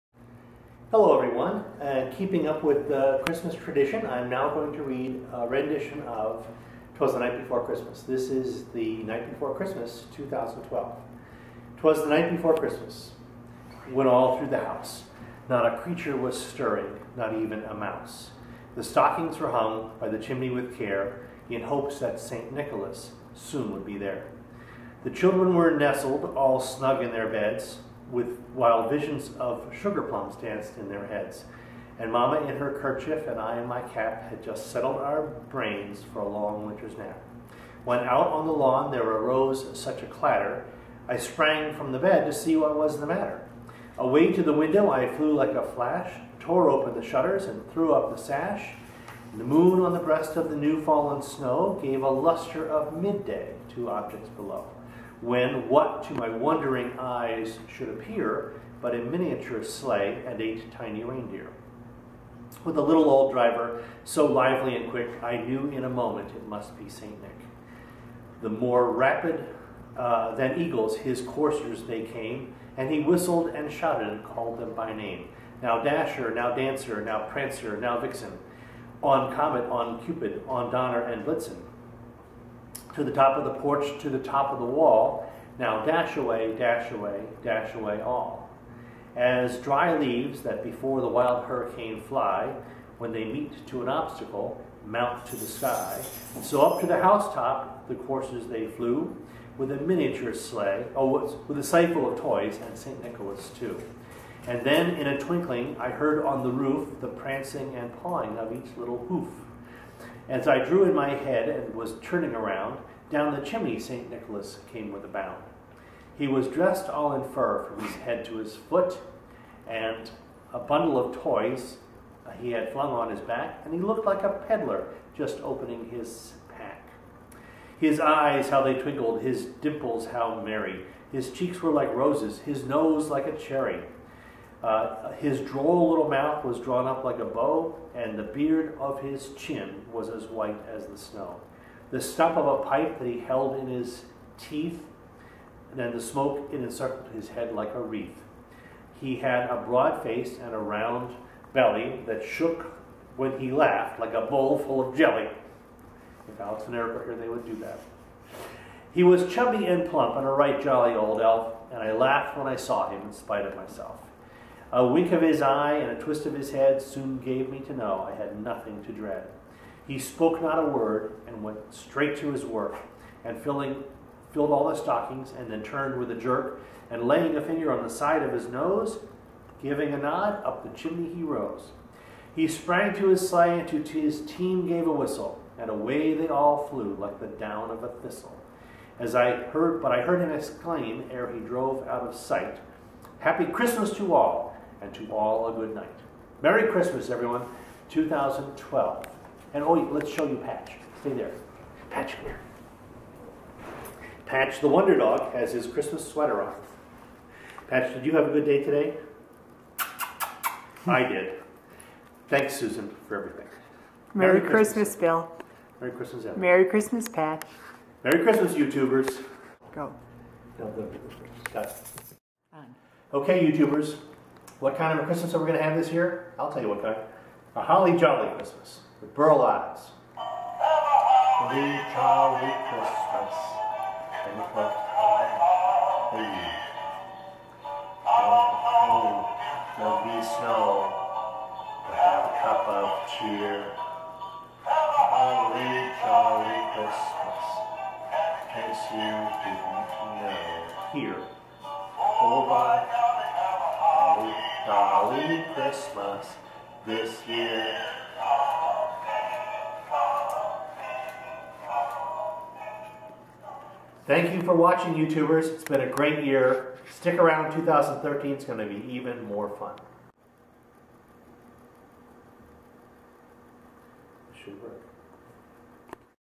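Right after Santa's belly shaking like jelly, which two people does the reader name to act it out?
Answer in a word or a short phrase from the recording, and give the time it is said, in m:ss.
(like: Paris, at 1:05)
Alex and Eric, at 2:36.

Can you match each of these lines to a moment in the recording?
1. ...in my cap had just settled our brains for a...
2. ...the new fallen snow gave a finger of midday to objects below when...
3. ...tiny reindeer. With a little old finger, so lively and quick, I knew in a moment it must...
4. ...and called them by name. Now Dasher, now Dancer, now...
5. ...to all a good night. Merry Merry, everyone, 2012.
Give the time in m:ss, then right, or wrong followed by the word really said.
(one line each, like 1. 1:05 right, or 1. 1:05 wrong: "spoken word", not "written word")
1. 0:33 right
2. 0:50 wrong: "luster", not "finger"
3. 1:00 wrong: "driver", not "finger"
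4. 1:14 right
5. 3:14 wrong: "Christmas", not "Merry".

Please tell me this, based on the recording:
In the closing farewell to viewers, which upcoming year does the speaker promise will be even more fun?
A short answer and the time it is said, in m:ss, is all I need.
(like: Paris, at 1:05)
2013, at 4:27.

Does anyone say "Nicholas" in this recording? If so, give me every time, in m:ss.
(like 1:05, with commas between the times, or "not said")
0:22, 1:43, 1:54.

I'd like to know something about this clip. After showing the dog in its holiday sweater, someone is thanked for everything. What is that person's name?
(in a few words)
Susan.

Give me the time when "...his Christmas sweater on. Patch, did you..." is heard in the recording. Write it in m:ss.
3:25.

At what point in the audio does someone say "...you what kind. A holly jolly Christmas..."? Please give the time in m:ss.
3:46.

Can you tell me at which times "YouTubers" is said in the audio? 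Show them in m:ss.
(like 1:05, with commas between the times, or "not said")
3:38, 3:43, 4:24.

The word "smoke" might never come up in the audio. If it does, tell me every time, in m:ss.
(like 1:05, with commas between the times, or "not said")
2:26.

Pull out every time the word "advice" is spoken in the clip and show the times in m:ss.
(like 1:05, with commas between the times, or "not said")
not said.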